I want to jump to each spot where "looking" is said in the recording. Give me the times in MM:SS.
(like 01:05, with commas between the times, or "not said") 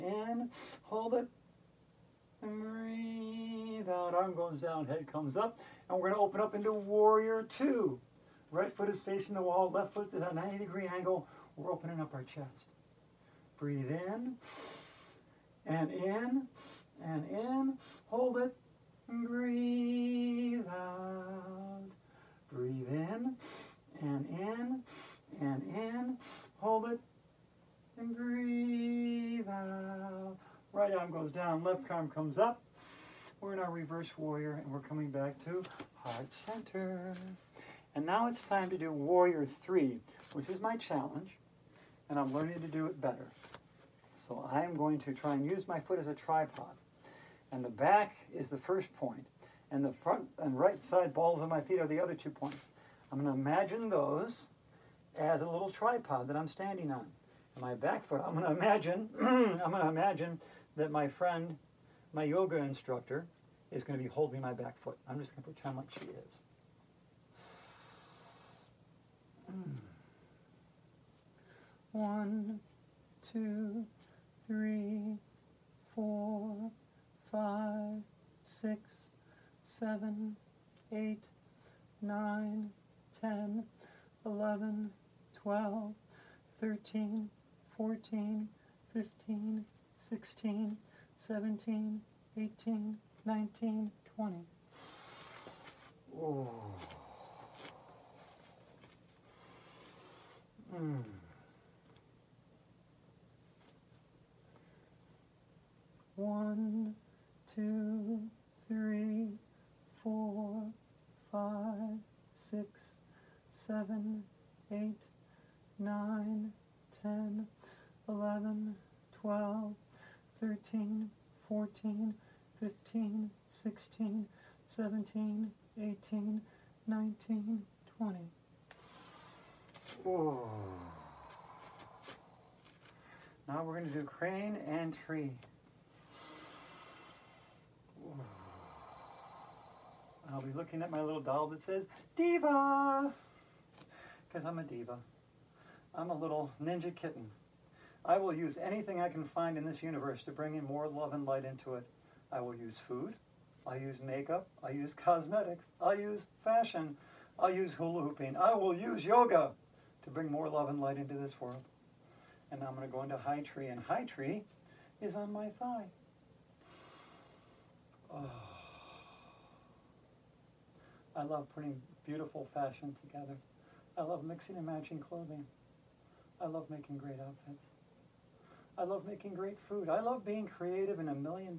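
02:20.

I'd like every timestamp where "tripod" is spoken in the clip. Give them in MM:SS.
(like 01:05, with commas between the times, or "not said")
00:46, 00:55.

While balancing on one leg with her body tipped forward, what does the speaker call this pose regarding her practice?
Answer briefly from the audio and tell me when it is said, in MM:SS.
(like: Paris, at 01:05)
my challenge, at 00:40.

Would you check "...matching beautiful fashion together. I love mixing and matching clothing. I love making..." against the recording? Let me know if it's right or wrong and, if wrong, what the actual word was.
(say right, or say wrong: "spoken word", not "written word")
wrong: "putting", not "matching".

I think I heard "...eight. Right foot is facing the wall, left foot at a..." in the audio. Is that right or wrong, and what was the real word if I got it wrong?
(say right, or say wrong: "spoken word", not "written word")
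wrong: "two", not "eight".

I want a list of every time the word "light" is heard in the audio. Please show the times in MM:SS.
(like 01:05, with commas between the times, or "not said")
02:31, 02:40.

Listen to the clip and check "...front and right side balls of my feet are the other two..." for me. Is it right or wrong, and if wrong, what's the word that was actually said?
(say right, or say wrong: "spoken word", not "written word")
right.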